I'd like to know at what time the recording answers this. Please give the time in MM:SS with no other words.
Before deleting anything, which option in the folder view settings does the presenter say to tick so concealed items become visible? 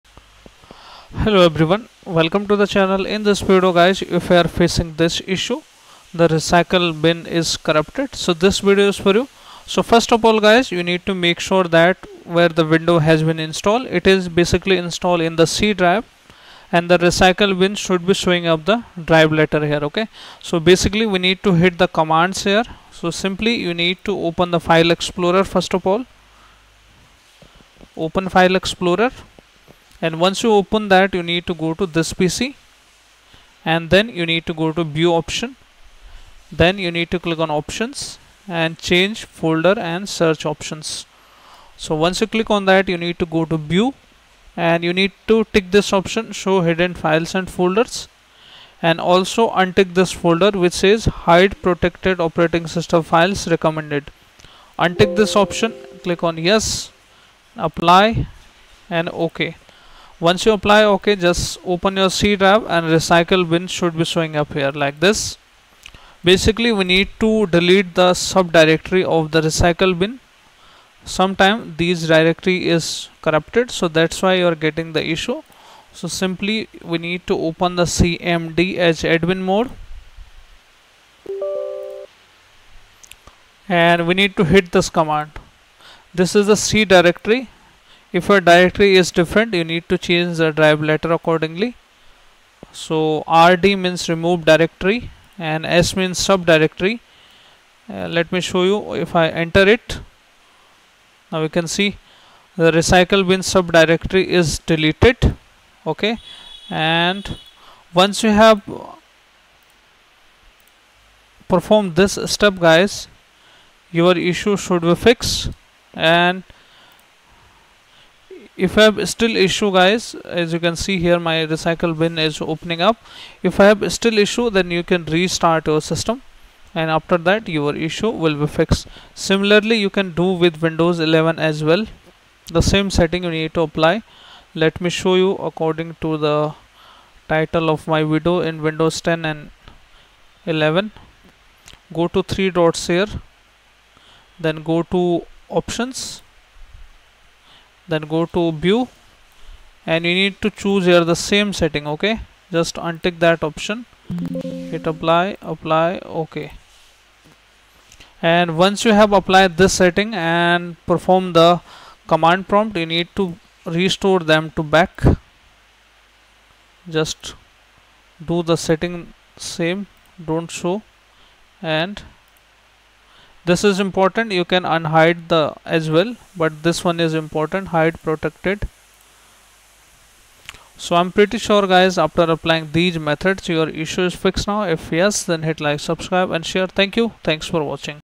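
00:46.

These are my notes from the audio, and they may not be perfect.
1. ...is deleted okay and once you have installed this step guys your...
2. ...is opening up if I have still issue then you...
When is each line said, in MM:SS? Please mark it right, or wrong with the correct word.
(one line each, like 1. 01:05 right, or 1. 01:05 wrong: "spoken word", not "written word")
1. 01:44 wrong: "performed", not "installed"
2. 02:02 right.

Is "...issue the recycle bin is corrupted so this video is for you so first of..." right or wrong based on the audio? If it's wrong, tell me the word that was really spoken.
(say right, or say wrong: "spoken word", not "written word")
right.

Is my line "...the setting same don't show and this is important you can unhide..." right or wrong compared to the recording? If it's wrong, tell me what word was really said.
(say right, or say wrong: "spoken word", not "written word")
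right.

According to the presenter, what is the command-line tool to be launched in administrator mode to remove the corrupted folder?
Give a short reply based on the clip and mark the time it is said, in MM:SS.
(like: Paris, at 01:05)
cmd, at 01:17.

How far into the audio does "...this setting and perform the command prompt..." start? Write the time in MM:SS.
02:39.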